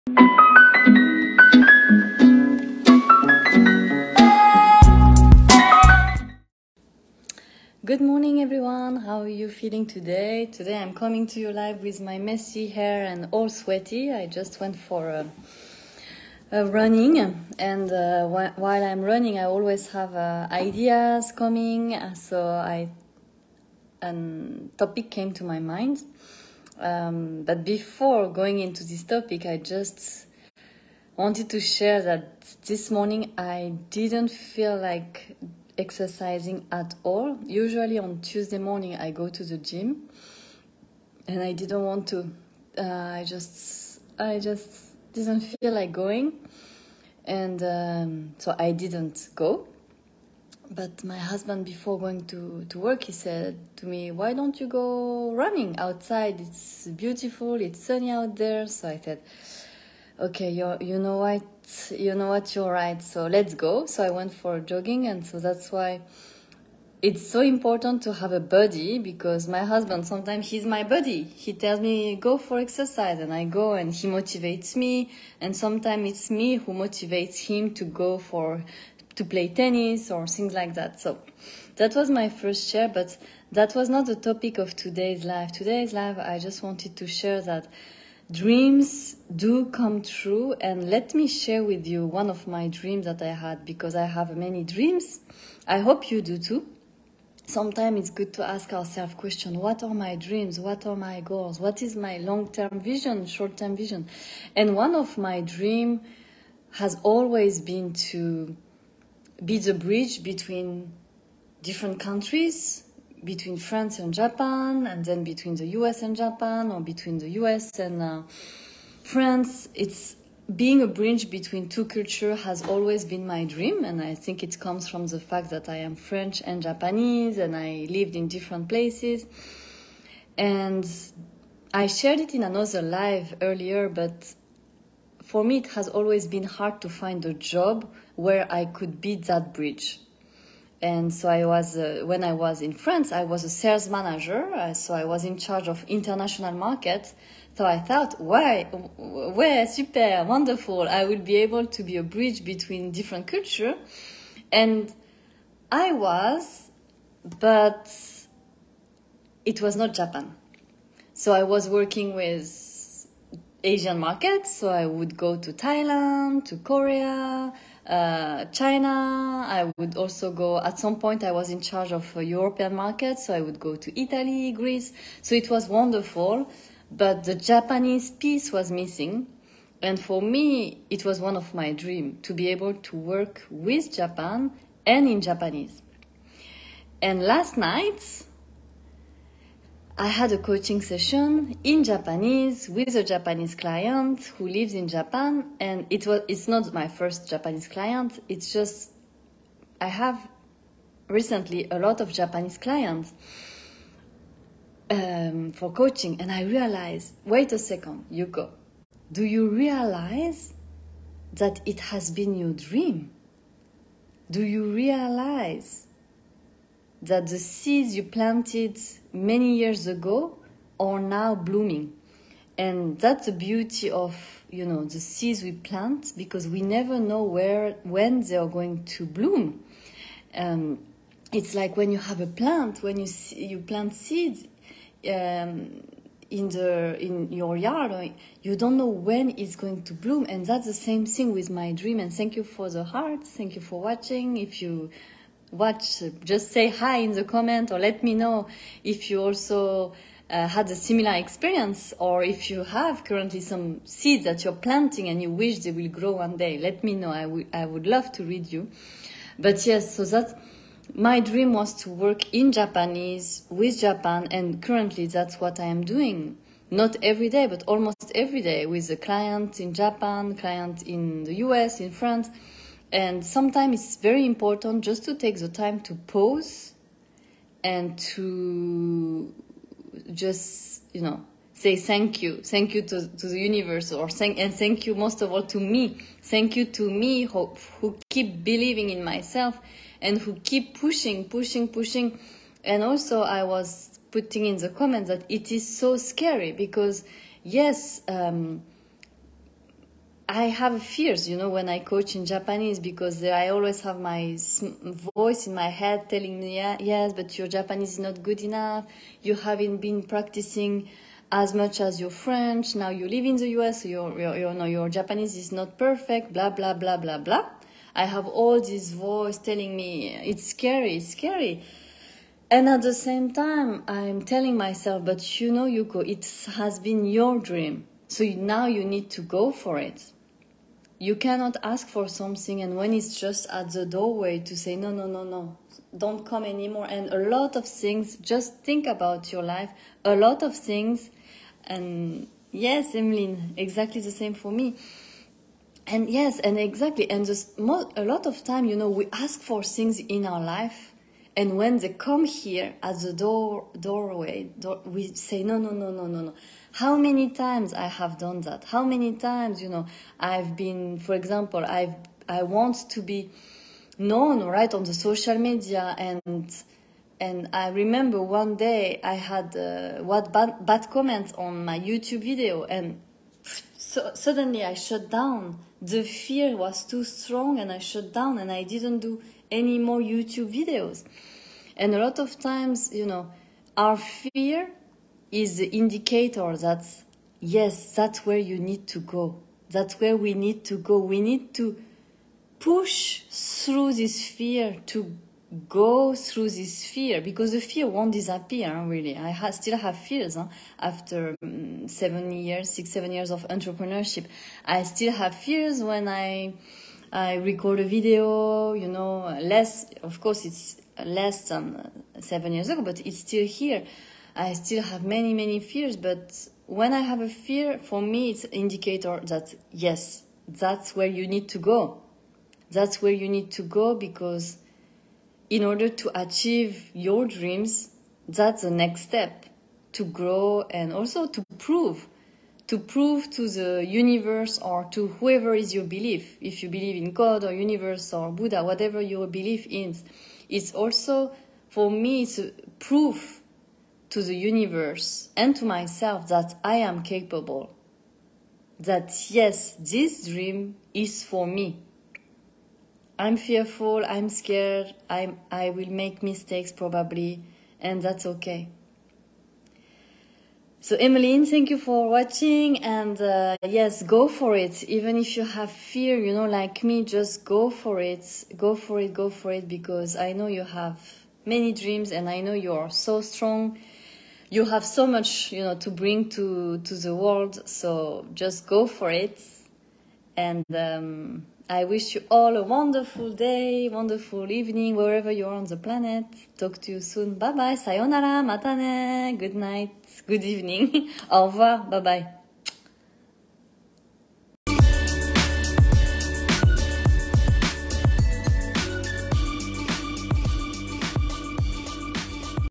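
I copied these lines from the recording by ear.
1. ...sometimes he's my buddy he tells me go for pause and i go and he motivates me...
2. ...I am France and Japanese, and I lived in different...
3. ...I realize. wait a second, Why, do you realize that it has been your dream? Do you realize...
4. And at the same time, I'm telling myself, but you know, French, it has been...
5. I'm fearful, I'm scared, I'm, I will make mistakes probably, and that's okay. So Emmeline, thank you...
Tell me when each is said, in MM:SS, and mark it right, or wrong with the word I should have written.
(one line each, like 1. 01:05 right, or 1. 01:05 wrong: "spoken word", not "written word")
1. 01:10 wrong: "exercise", not "pause"
2. 02:05 wrong: "French", not "France"
3. 03:26 wrong: "Yuko", not "Why"
4. 05:22 wrong: "Yuko", not "French"
5. 07:33 right.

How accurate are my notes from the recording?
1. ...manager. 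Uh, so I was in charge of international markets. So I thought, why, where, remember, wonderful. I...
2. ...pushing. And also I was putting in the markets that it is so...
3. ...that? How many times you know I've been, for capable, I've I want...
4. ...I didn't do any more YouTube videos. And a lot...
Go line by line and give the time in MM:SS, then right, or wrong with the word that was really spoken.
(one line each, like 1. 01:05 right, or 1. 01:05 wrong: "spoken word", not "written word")
1. 02:23 wrong: "super", not "remember"
2. 04:51 wrong: "comments", not "markets"
3. 05:58 wrong: "example", not "capable"
4. 06:18 right.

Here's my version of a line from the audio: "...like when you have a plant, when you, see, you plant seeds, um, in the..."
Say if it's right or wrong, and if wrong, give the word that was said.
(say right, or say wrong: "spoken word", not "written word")
right.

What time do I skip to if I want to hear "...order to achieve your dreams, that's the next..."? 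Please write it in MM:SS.
07:05.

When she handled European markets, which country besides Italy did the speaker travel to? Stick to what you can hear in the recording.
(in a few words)
Greece.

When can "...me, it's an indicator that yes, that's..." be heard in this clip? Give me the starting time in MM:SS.
06:58.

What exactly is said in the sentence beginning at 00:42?
Uh, I just, I just didn't feel like going.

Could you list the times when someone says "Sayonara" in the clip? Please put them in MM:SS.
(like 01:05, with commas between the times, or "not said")
08:07.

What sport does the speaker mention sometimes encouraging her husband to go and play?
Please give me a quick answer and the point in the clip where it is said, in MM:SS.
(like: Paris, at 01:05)
Tennis, at 01:19.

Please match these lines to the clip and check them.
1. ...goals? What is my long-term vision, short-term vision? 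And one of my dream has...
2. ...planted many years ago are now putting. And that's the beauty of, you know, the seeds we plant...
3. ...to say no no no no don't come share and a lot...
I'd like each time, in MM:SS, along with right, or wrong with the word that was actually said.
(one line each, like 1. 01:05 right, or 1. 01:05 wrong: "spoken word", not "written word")
1. 01:41 right
2. 03:38 wrong: "blooming", not "putting"
3. 05:34 wrong: "anymore", not "share".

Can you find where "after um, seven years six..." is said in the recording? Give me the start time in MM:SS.
06:40.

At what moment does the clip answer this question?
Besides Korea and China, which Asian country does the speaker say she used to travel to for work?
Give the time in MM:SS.
02:45.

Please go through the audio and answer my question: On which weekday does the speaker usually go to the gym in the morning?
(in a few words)
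Tuesday.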